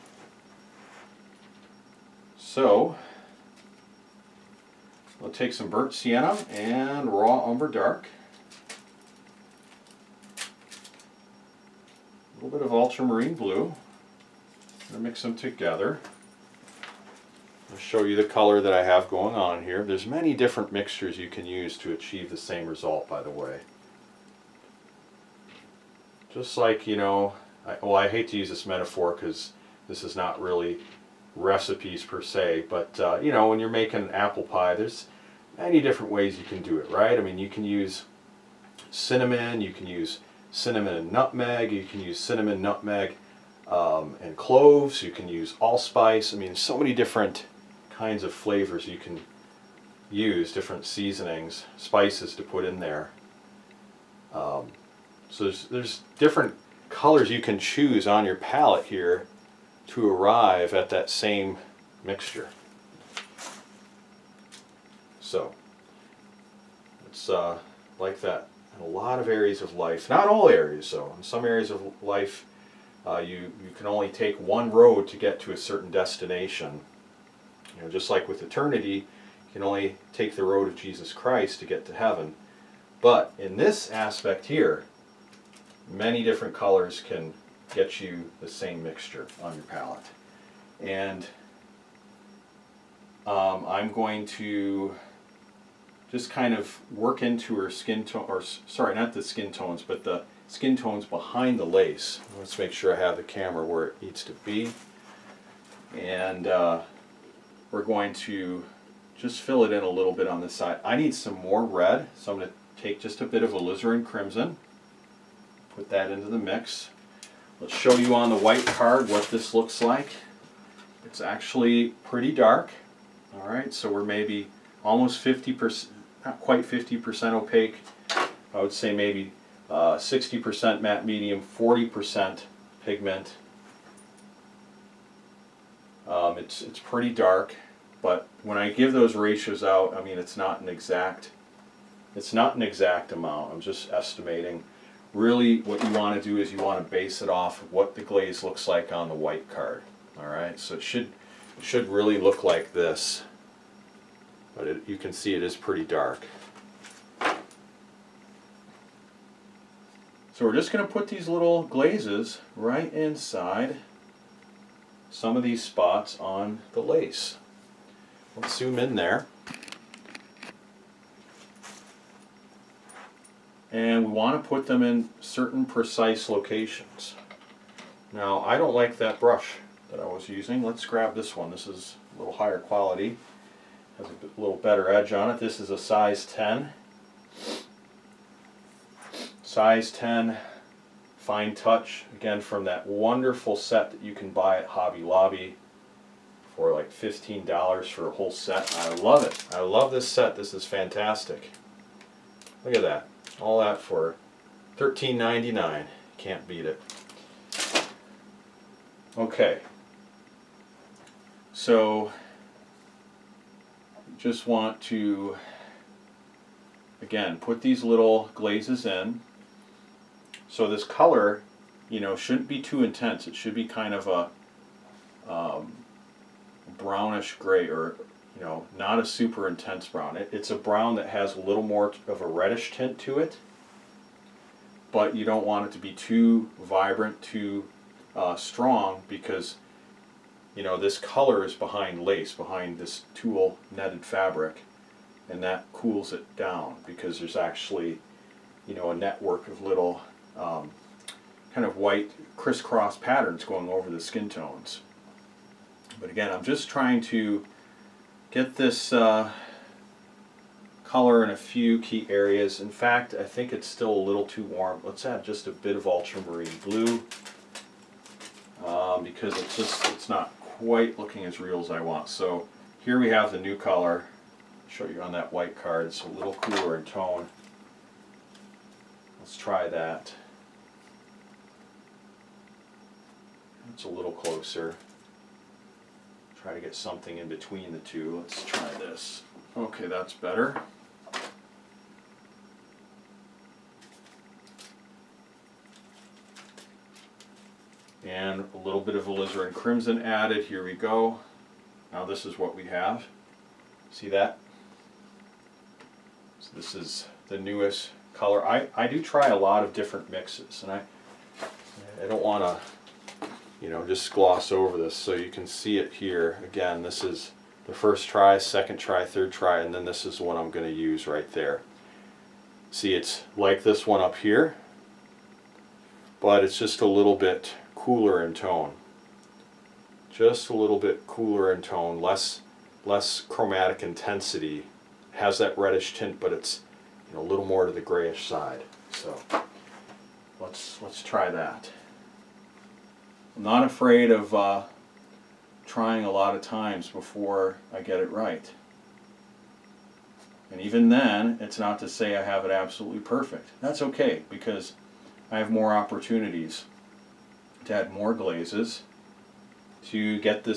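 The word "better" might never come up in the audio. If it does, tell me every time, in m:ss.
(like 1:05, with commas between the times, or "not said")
3:04, 4:50.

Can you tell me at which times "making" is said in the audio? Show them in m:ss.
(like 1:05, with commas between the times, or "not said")
0:33.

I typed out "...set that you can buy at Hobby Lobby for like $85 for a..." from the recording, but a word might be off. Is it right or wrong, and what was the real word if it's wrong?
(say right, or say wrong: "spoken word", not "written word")
wrong: "15", not "85".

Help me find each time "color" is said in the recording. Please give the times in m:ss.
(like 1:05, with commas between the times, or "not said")
0:18, 0:56, 1:26, 3:40, 4:00, 4:20, 4:33, 5:08.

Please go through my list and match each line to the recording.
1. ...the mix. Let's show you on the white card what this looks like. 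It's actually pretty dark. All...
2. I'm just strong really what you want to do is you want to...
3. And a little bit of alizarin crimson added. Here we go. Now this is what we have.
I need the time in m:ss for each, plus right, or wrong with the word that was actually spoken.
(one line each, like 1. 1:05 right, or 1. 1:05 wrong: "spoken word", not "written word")
1. 1:56 right
2. 2:23 wrong: "estimating", not "strong"
3. 4:58 right.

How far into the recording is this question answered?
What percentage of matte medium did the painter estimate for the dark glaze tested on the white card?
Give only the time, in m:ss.
2:09.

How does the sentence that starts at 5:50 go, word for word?
And even then, it's not to say I have it absolutely perfect.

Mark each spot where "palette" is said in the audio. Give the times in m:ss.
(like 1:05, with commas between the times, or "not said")
0:58, 1:29.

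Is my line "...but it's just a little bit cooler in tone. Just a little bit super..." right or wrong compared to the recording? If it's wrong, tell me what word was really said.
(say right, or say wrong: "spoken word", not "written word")
wrong: "cooler", not "super".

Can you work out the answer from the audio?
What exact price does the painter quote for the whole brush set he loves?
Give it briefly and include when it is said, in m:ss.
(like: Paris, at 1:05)
$13.99, at 3:24.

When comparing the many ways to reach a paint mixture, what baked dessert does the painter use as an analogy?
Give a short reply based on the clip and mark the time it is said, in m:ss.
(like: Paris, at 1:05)
apple pie, at 0:34.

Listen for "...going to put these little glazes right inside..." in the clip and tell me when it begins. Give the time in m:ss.
2:40.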